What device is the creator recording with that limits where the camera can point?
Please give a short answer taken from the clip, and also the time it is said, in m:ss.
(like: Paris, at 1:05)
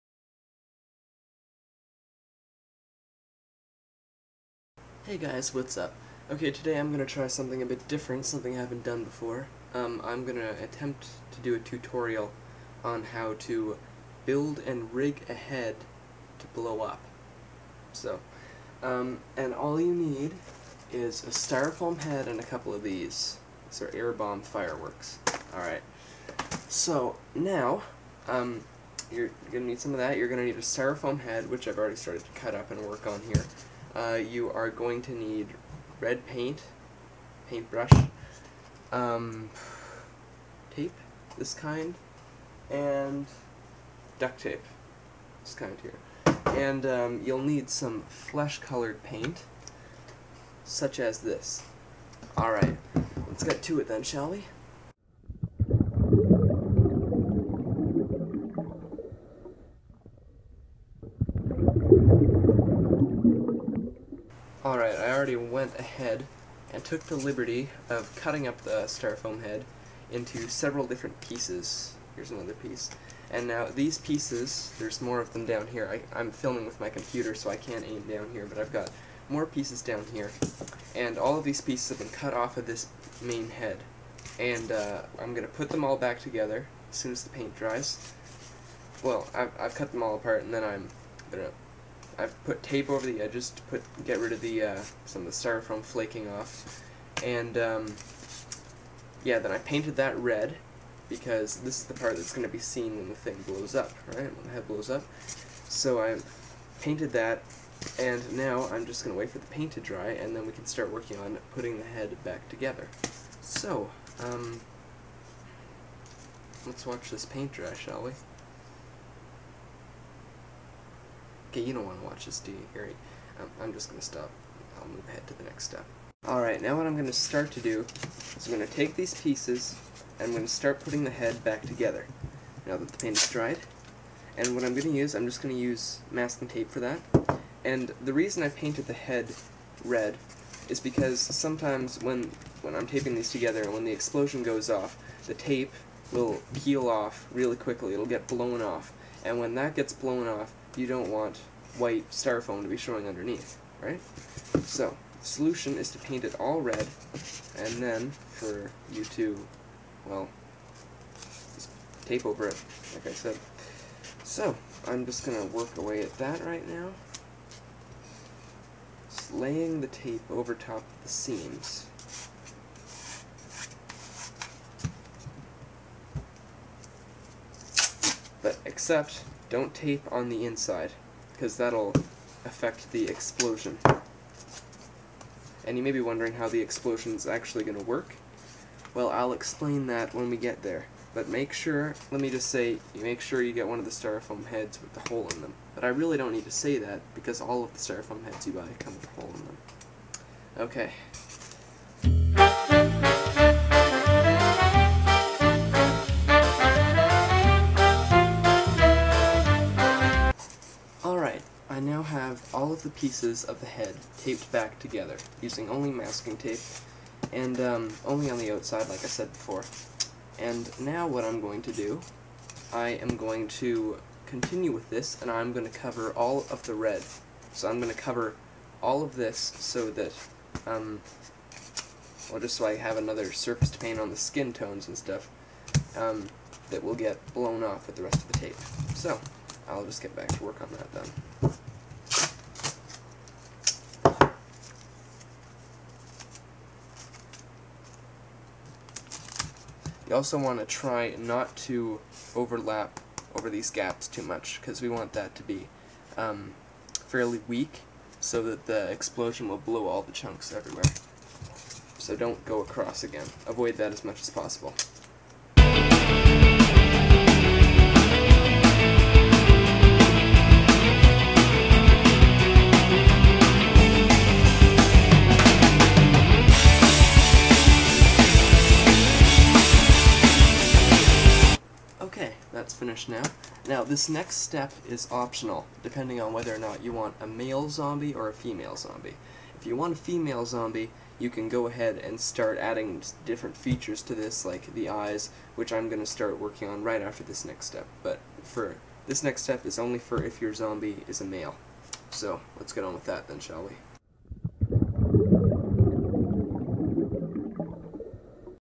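Computer, at 1:16.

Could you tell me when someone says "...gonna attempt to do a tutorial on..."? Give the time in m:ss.
0:10.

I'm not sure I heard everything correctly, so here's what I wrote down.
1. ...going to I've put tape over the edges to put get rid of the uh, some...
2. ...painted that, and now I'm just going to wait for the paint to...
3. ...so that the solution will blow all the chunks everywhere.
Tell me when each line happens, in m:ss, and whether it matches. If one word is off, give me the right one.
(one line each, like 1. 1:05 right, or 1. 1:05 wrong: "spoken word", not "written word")
1. 1:31 right
2. 1:46 right
3. 4:18 wrong: "explosion", not "solution".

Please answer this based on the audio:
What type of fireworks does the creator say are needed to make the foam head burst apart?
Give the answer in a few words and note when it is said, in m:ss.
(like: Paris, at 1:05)
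Air bomb fireworks, at 0:23.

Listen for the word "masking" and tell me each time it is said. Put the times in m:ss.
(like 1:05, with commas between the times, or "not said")
2:16, 3:35.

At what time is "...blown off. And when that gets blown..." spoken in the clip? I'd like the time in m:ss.
2:28.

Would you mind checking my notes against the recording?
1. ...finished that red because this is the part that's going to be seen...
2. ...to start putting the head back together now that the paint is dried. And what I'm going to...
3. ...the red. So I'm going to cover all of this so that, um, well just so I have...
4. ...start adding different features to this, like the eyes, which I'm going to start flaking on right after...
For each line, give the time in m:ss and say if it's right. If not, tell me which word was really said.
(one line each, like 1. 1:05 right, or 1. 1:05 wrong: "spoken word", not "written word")
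1. 1:39 wrong: "painted", not "finished"
2. 2:10 right
3. 3:46 right
4. 4:52 wrong: "working", not "flaking".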